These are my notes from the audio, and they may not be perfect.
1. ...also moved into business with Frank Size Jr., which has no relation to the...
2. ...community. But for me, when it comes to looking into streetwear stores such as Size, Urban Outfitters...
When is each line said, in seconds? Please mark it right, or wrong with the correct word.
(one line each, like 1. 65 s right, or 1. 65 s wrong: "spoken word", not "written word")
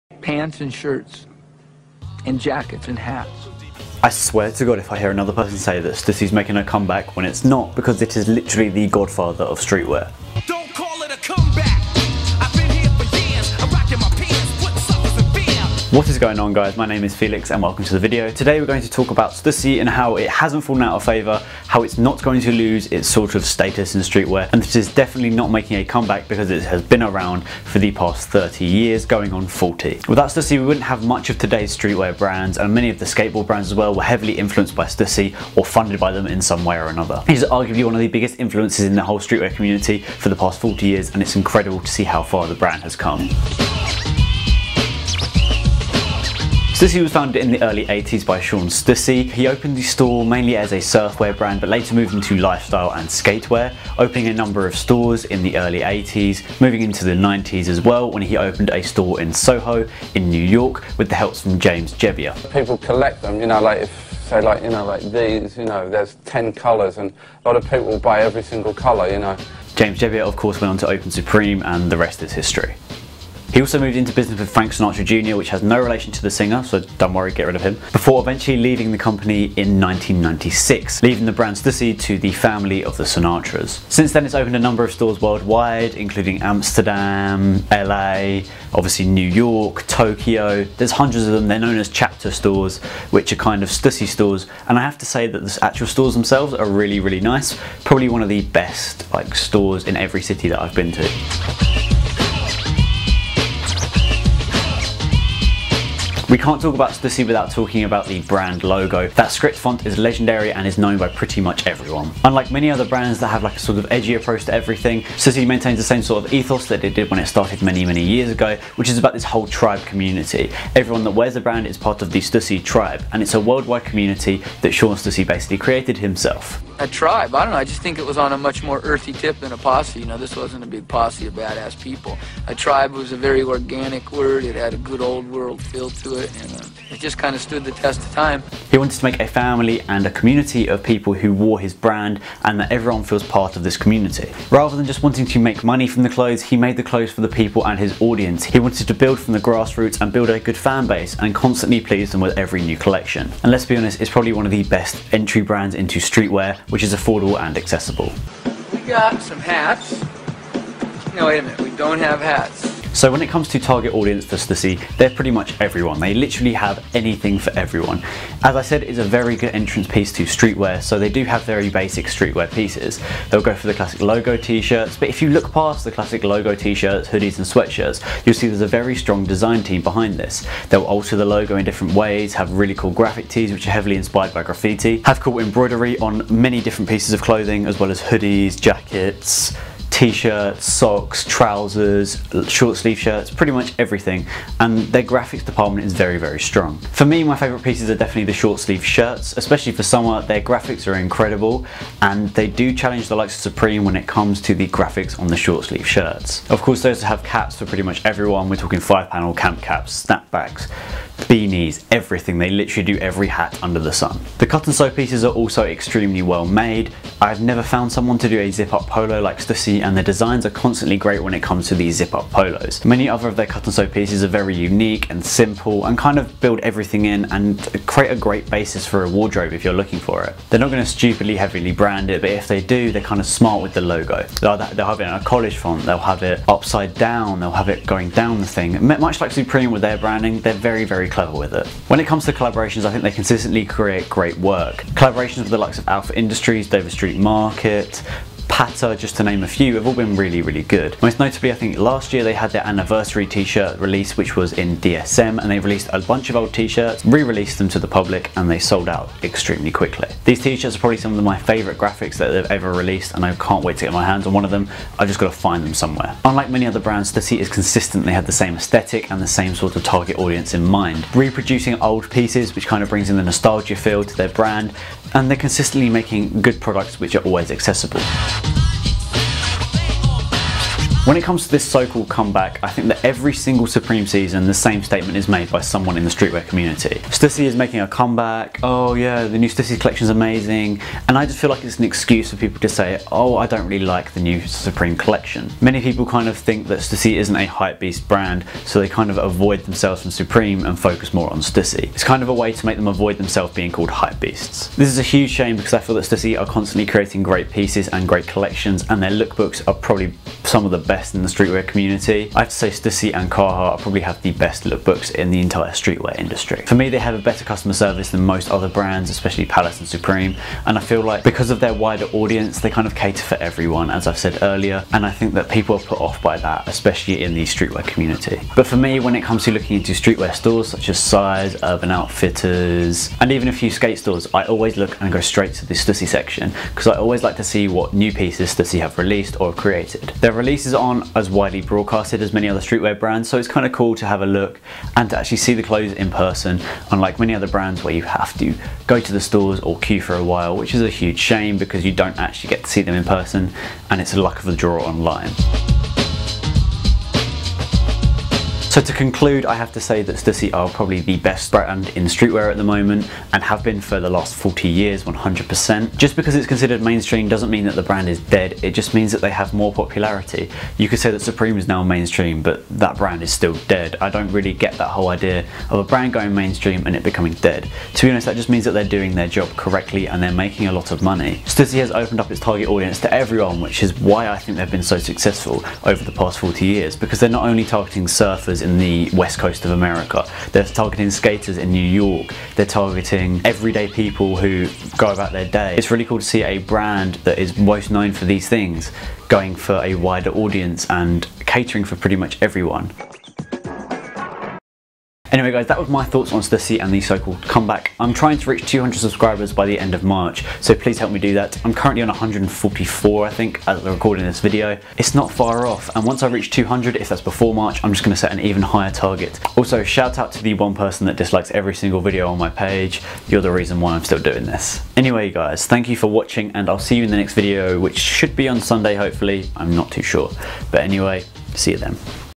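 1. 73 s wrong: "Sinatra", not "Size"
2. 327 s right.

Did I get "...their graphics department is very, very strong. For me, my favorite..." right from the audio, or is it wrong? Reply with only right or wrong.
right.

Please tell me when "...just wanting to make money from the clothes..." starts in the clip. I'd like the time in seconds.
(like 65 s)
144 s.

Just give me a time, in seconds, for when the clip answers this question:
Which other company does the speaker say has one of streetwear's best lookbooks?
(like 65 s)
313 s.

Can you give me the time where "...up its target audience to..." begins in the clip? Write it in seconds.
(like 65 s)
382 s.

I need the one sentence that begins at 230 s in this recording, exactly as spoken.
They're not going to stupidly heavily brand it, but if they do, they're kind of smart with the logo.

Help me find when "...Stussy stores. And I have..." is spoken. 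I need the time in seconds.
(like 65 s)
93 s.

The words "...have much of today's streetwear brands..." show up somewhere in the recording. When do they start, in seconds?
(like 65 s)
30 s.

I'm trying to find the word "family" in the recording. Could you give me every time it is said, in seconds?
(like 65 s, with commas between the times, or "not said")
82 s, 139 s.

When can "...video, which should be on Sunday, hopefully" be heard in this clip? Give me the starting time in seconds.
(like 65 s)
427 s.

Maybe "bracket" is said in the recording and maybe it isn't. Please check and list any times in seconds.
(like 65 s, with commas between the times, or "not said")
not said.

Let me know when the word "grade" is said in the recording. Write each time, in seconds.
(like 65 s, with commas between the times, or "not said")
not said.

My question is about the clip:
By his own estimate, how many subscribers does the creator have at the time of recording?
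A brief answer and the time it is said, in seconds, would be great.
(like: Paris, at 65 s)
144, at 412 s.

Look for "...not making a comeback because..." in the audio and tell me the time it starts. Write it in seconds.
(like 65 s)
25 s.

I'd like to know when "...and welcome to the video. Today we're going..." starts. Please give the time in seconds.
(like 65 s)
17 s.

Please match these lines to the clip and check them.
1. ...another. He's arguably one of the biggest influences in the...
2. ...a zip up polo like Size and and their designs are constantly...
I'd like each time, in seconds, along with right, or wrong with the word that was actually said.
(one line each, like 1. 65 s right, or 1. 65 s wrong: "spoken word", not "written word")
1. 36 s right
2. 218 s wrong: "Stussy", not "Size".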